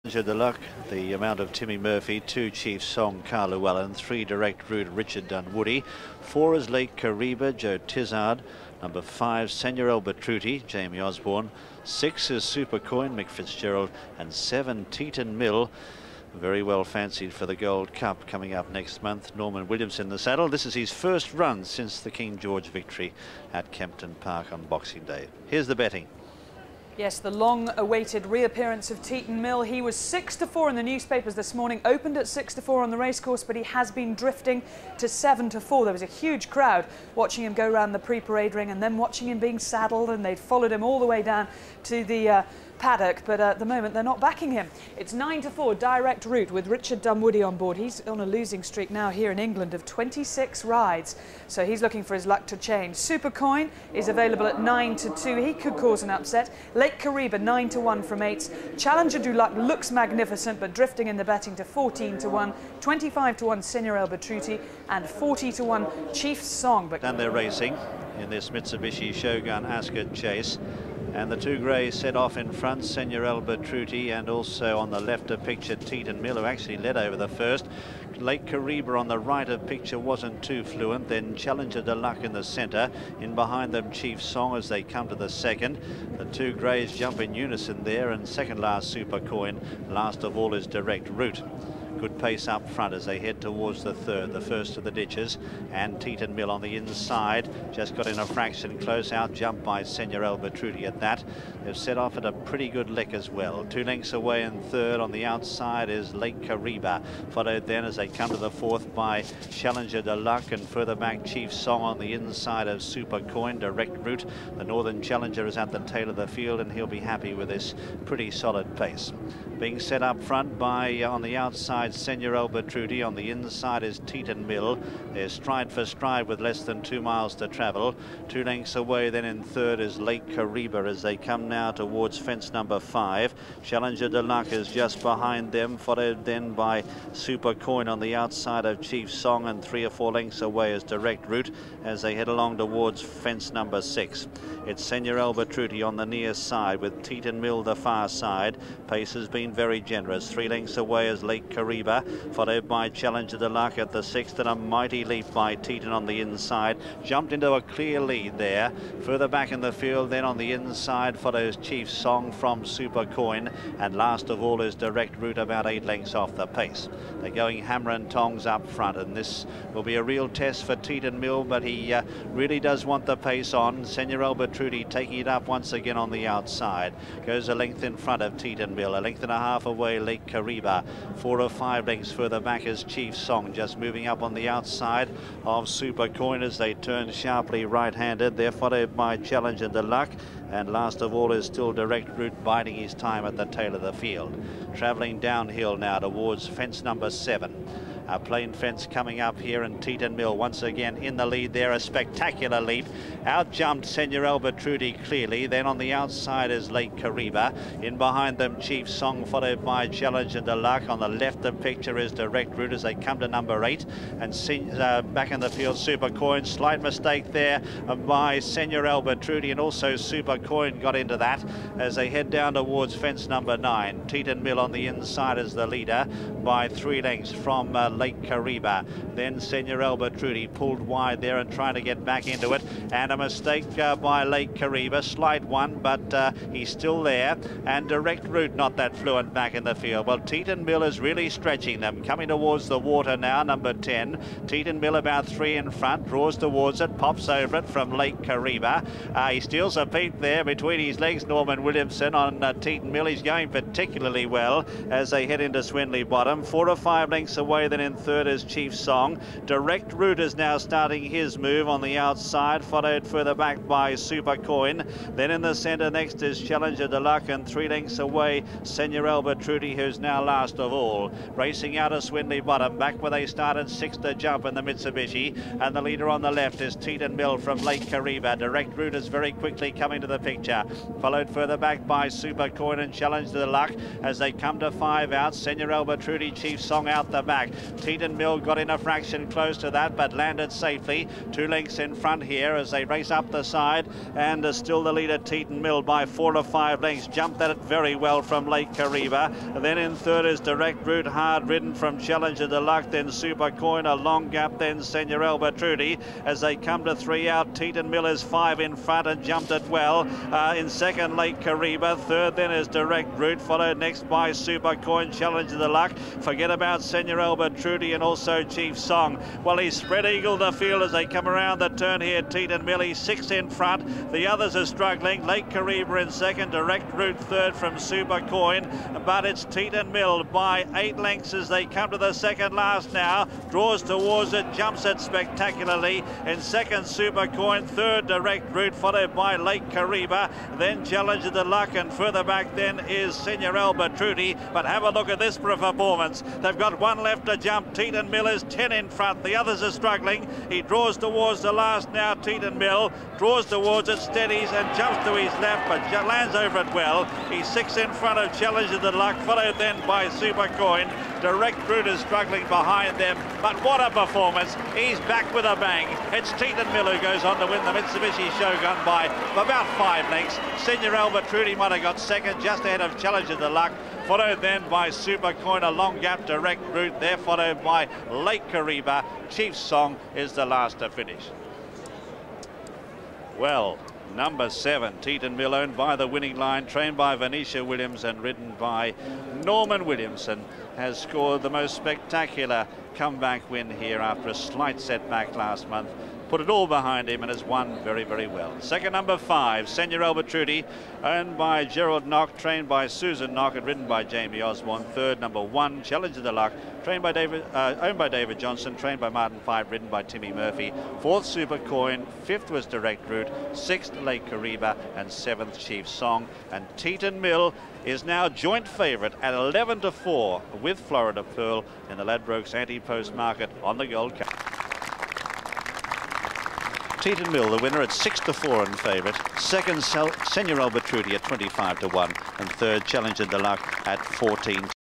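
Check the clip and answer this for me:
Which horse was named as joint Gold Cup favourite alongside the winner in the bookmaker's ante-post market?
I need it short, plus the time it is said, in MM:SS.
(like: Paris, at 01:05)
Florida Pearl, at 07:00.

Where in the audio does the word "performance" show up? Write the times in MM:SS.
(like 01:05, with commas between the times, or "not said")
05:45, 06:03.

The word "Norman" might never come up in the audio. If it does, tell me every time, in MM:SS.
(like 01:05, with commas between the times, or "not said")
00:19, 04:11, 06:29.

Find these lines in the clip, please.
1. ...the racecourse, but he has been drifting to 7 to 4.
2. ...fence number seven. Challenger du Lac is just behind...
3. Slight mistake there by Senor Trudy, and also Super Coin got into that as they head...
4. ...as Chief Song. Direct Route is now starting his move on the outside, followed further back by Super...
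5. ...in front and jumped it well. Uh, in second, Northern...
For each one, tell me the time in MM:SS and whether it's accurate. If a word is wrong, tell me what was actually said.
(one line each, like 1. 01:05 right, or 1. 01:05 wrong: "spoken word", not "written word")
1. 00:32 right
2. 02:12 wrong: "five", not "seven"
3. 03:36 right
4. 04:18 right
5. 05:08 wrong: "Lake", not "Northern".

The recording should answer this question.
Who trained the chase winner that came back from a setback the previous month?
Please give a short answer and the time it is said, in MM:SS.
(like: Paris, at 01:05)
Venetia Williams, at 06:27.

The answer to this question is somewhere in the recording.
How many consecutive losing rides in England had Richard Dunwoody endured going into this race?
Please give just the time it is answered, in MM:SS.
00:49.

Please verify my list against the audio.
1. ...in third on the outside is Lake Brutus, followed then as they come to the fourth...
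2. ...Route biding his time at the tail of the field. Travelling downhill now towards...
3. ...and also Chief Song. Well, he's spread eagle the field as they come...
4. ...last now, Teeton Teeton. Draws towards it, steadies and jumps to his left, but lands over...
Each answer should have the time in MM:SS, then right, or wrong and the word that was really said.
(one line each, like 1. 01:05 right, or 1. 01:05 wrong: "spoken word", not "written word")
1. 01:44 wrong: "Kariba", not "Brutus"
2. 03:12 right
3. 05:17 right
4. 05:51 wrong: "Mill", not "Teeton".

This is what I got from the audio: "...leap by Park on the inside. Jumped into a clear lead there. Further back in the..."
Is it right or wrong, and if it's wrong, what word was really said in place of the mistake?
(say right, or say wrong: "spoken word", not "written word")
wrong: "Teeton", not "Park".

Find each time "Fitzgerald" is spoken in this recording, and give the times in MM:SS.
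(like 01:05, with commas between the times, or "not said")
00:13.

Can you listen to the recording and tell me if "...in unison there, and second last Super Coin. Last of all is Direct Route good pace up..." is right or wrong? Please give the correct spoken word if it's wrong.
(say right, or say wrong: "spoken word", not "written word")
right.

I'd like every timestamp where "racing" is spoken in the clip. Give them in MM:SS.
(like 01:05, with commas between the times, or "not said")
01:07, 04:31.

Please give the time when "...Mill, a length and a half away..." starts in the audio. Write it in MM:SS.
02:58.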